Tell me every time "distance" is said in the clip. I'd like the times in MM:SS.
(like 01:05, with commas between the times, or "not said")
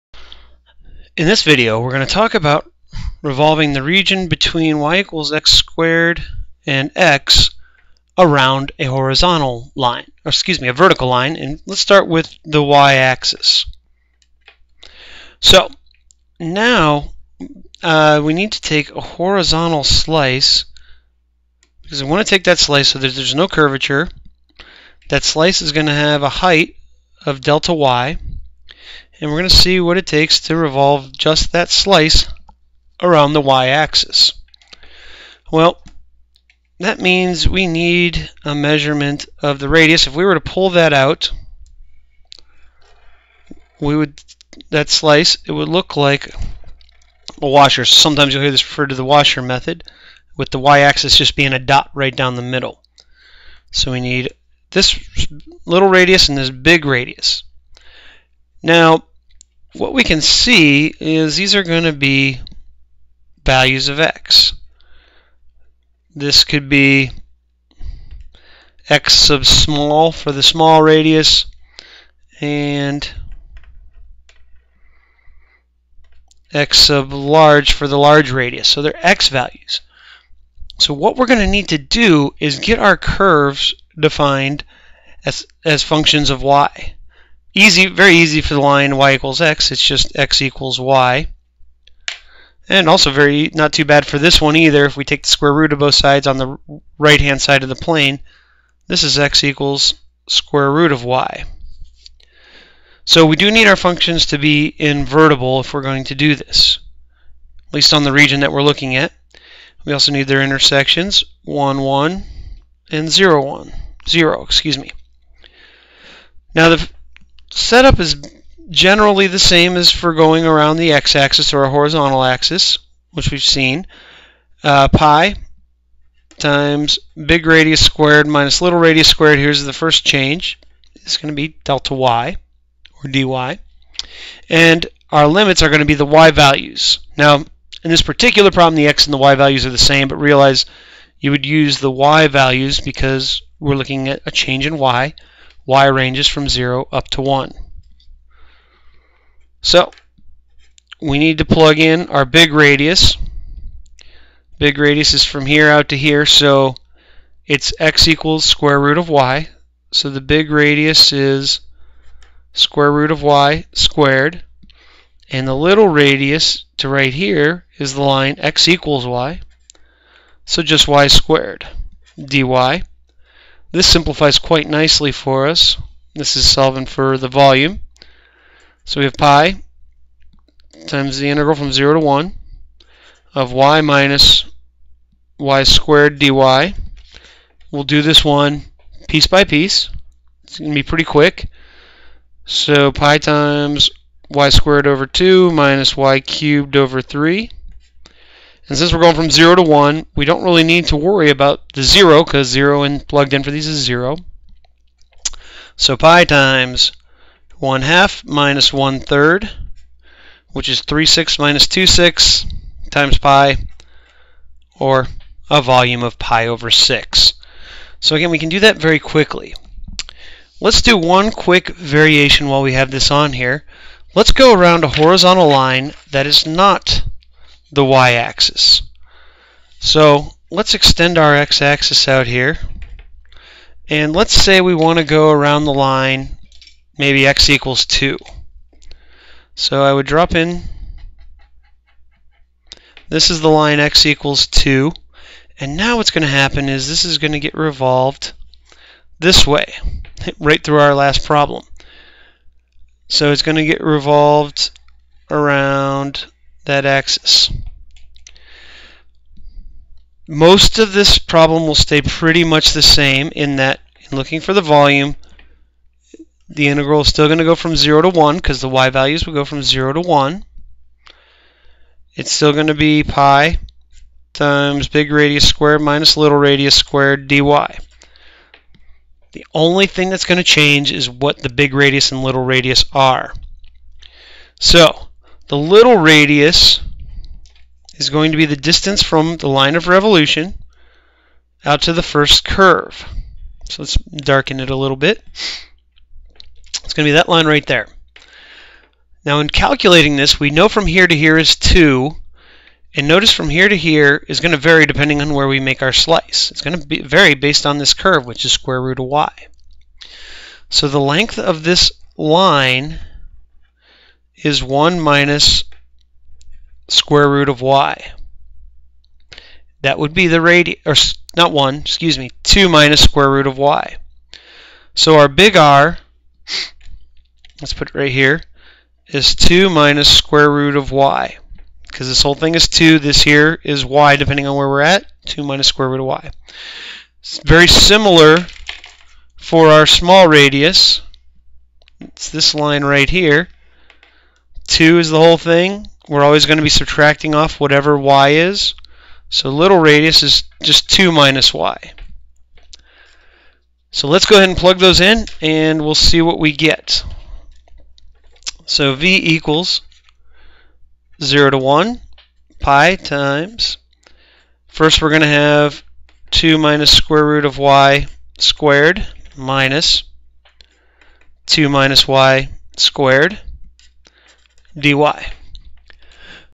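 04:48.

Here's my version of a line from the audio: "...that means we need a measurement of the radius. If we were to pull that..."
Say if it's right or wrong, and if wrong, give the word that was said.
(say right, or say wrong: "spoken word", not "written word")
right.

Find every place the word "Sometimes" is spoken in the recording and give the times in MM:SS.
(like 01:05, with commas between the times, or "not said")
00:47.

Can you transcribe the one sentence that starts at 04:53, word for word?
So let's darken it a little bit.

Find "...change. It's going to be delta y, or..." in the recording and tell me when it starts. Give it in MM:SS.
02:10.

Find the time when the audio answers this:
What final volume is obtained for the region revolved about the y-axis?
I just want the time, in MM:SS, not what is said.
03:36.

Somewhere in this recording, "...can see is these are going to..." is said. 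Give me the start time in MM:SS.
01:00.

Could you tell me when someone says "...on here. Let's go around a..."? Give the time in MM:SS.
03:43.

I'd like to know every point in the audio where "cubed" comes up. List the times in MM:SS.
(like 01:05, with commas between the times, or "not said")
03:16.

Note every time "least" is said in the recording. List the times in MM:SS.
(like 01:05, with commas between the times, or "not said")
01:47.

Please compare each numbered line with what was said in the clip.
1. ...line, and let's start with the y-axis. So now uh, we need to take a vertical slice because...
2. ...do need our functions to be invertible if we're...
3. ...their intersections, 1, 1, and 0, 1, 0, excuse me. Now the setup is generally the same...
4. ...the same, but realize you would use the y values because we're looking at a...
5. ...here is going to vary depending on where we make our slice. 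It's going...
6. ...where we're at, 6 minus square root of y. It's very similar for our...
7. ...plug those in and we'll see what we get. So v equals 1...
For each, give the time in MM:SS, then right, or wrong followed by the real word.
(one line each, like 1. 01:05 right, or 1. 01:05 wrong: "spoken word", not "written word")
1. 00:11 wrong: "horizontal", not "vertical"
2. 01:43 right
3. 01:50 right
4. 02:19 right
5. 05:03 right
6. 05:34 wrong: "2", not "6"
7. 05:54 wrong: "0", not "1".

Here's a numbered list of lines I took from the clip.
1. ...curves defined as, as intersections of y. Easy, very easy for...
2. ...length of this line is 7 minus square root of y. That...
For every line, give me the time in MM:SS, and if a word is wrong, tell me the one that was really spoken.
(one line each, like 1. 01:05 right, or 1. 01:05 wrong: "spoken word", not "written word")
1. 01:22 wrong: "functions", not "intersections"
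2. 05:11 wrong: "1", not "7".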